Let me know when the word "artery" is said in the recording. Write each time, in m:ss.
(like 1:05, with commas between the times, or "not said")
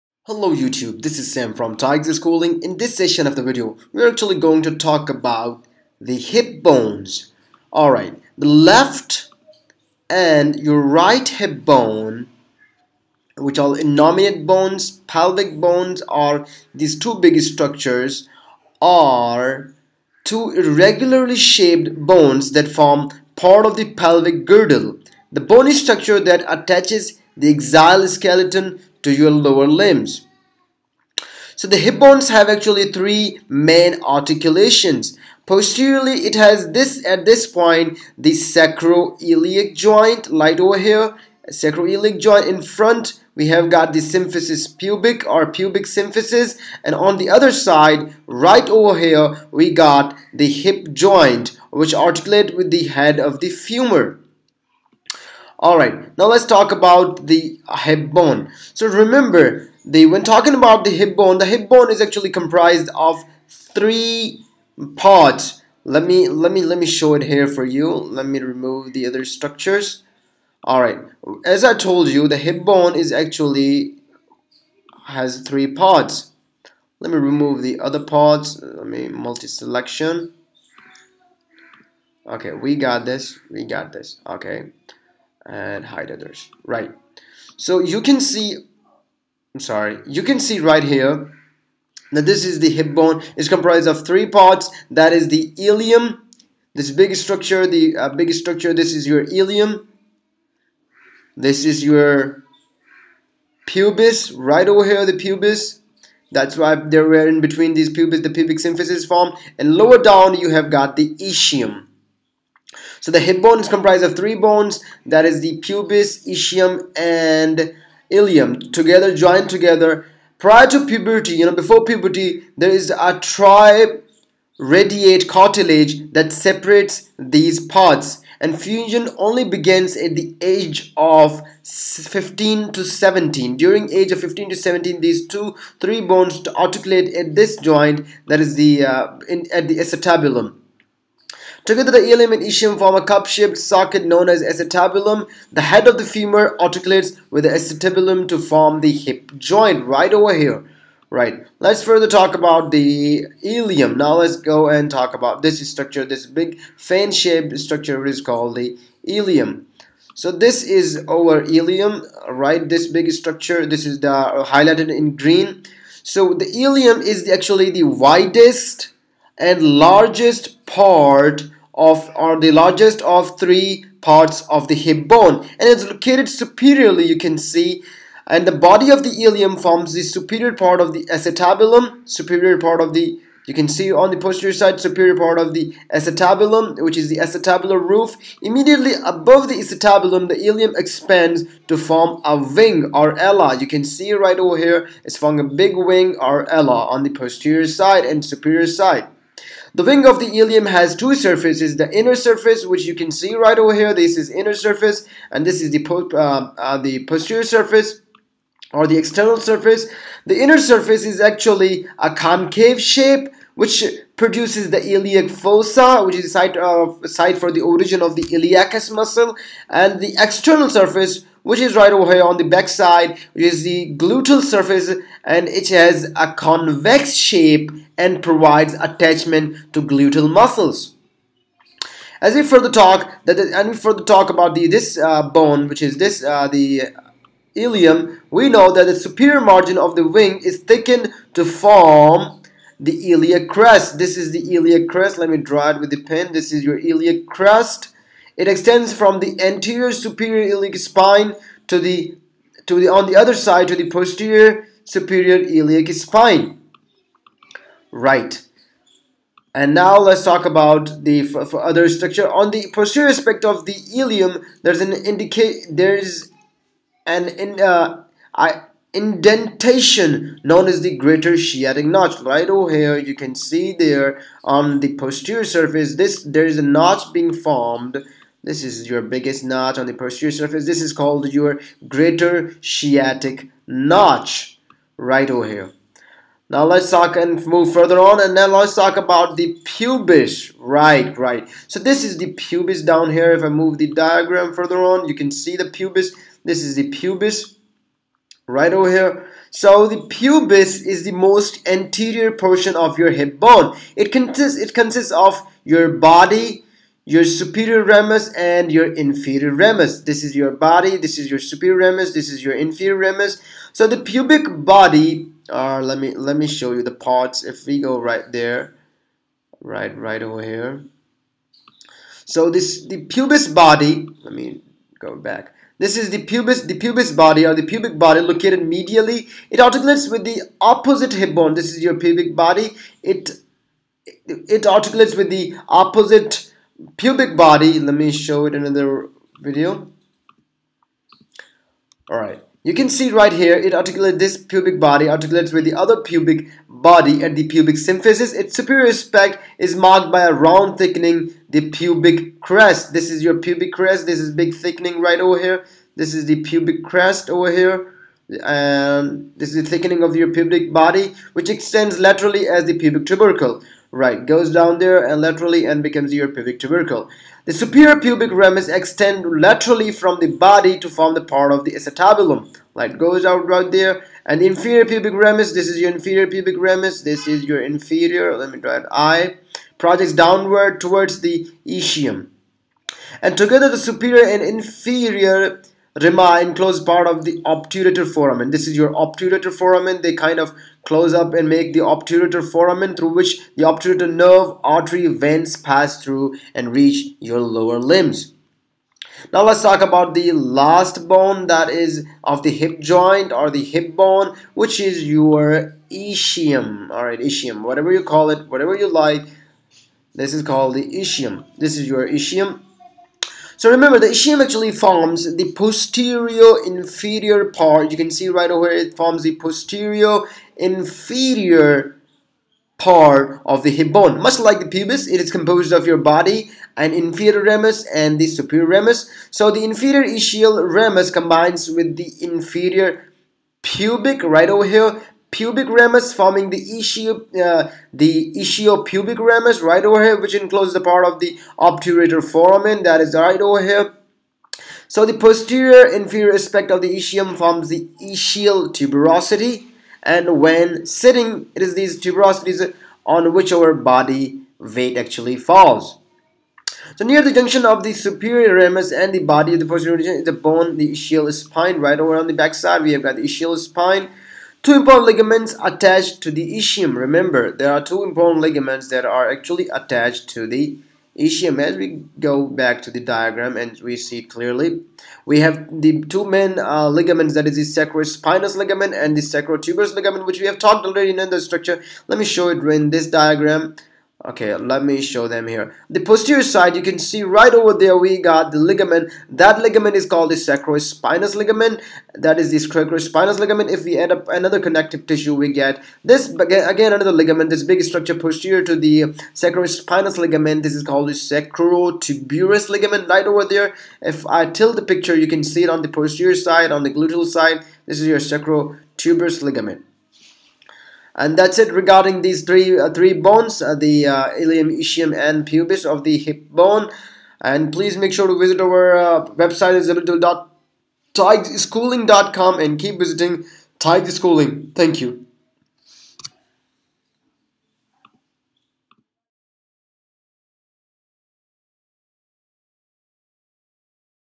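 6:34.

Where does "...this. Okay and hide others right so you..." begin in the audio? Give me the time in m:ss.
1:23.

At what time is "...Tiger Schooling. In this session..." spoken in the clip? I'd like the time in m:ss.
0:01.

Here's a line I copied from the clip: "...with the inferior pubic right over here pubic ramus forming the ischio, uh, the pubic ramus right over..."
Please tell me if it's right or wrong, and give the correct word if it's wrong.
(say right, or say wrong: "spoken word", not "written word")
right.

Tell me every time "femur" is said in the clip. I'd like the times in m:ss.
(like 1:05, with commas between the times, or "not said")
0:53, 2:26.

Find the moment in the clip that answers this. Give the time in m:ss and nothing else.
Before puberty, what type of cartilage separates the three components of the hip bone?
2:03.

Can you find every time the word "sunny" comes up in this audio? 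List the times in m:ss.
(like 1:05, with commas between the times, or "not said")
not said.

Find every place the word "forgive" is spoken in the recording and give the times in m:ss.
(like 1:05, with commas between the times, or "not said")
not said.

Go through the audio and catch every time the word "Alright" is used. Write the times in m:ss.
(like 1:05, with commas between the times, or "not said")
0:07, 0:55, 1:10.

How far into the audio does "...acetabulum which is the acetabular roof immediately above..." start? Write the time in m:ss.
3:05.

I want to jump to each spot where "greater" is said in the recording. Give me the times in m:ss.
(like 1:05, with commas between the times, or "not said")
4:30, 4:41.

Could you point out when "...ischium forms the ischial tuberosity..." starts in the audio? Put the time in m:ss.
7:26.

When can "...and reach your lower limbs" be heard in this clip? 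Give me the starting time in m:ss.
6:36.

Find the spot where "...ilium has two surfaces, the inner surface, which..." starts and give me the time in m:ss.
3:20.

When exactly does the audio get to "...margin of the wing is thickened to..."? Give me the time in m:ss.
3:59.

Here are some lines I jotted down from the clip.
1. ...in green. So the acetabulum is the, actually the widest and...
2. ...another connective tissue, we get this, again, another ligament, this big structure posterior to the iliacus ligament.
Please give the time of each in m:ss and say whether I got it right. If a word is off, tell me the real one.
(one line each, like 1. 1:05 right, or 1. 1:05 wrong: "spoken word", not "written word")
1. 2:44 wrong: "ilium", not "acetabulum"
2. 8:14 wrong: "sacrospinous", not "iliacus".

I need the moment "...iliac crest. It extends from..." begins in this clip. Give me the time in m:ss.
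4:06.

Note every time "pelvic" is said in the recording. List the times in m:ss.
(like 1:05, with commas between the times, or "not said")
0:15, 0:23.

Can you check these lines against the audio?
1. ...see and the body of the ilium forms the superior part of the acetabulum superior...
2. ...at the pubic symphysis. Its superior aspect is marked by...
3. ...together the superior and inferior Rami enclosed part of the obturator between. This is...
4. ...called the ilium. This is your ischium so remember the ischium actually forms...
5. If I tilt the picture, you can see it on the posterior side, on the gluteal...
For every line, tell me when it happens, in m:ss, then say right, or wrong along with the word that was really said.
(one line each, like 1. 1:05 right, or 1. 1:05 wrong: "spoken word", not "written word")
1. 2:57 right
2. 5:47 right
3. 6:23 wrong: "foramen", not "between"
4. 6:50 wrong: "ischium", not "ilium"
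5. 8:24 right.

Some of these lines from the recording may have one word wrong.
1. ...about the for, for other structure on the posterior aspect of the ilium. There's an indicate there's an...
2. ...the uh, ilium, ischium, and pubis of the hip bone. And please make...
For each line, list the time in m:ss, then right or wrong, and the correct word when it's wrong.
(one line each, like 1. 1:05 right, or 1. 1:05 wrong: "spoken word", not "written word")
1. 4:20 right
2. 8:33 right.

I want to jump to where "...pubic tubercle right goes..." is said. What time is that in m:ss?
6:02.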